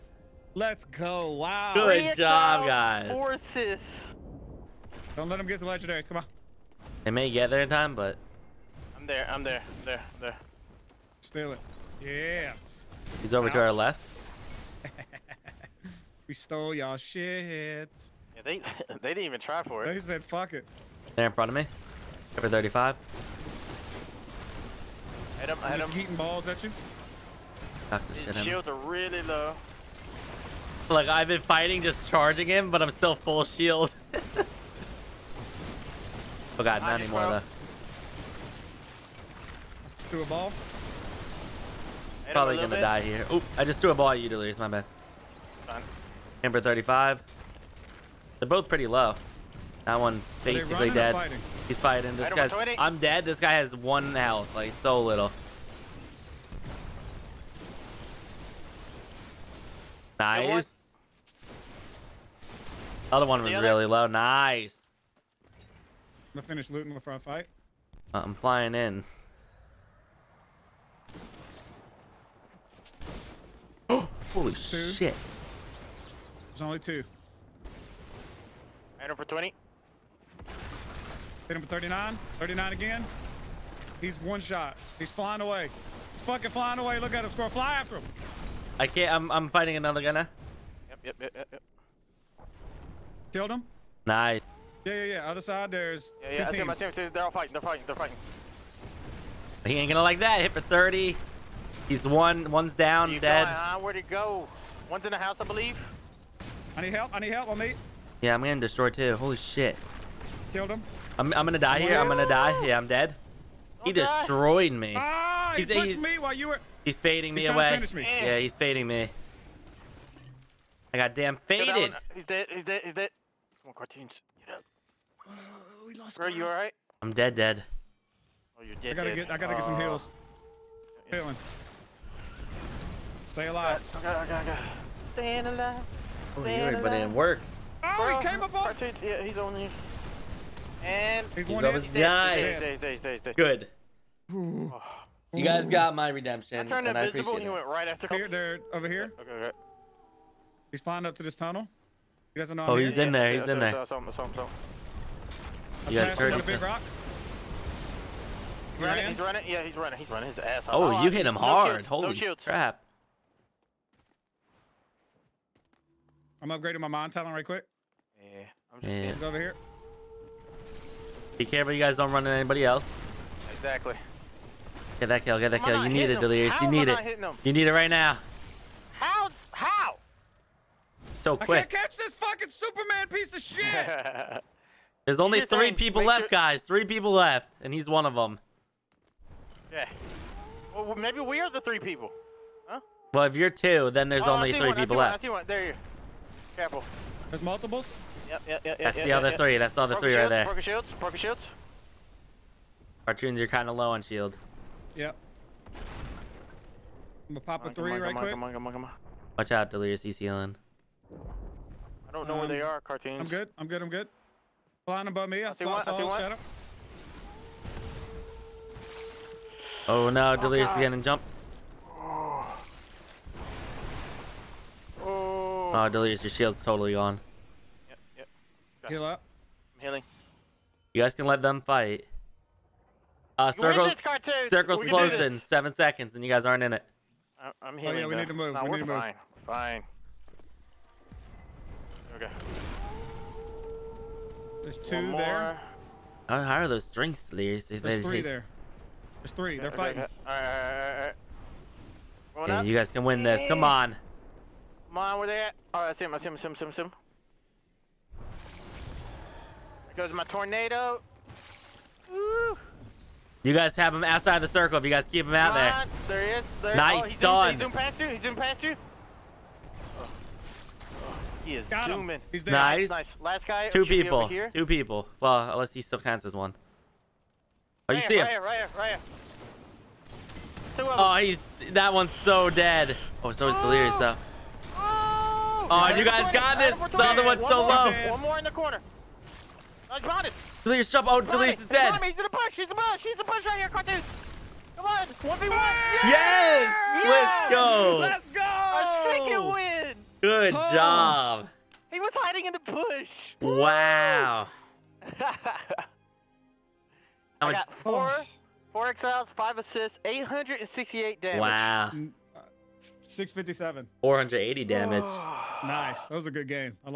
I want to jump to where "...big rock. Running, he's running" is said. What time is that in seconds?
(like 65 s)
156 s.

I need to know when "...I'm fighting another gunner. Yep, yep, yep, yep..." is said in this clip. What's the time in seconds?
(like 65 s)
89 s.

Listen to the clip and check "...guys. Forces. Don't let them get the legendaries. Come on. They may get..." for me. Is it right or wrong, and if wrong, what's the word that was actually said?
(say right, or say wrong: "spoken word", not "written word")
right.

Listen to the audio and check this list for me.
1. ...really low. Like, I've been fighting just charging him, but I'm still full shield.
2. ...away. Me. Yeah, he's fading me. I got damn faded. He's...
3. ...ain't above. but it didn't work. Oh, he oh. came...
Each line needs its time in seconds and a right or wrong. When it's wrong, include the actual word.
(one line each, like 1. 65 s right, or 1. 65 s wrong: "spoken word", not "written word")
1. 28 s right
2. 117 s right
3. 136 s wrong: "alive", not "above".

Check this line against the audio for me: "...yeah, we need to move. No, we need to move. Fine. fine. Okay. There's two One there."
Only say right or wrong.
right.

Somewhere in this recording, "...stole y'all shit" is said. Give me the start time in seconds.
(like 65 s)
16 s.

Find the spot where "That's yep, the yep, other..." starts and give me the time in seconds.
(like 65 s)
198 s.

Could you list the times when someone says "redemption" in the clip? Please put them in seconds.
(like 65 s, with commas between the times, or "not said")
146 s.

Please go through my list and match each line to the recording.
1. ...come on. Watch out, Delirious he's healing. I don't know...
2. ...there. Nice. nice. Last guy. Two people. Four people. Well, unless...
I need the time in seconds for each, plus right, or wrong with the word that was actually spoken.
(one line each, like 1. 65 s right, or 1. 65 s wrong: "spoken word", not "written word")
1. 208 s right
2. 272 s wrong: "Two", not "Four".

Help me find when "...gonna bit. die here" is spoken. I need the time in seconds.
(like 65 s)
42 s.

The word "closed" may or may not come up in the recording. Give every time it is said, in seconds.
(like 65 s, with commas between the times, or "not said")
234 s.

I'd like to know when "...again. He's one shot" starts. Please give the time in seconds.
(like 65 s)
82 s.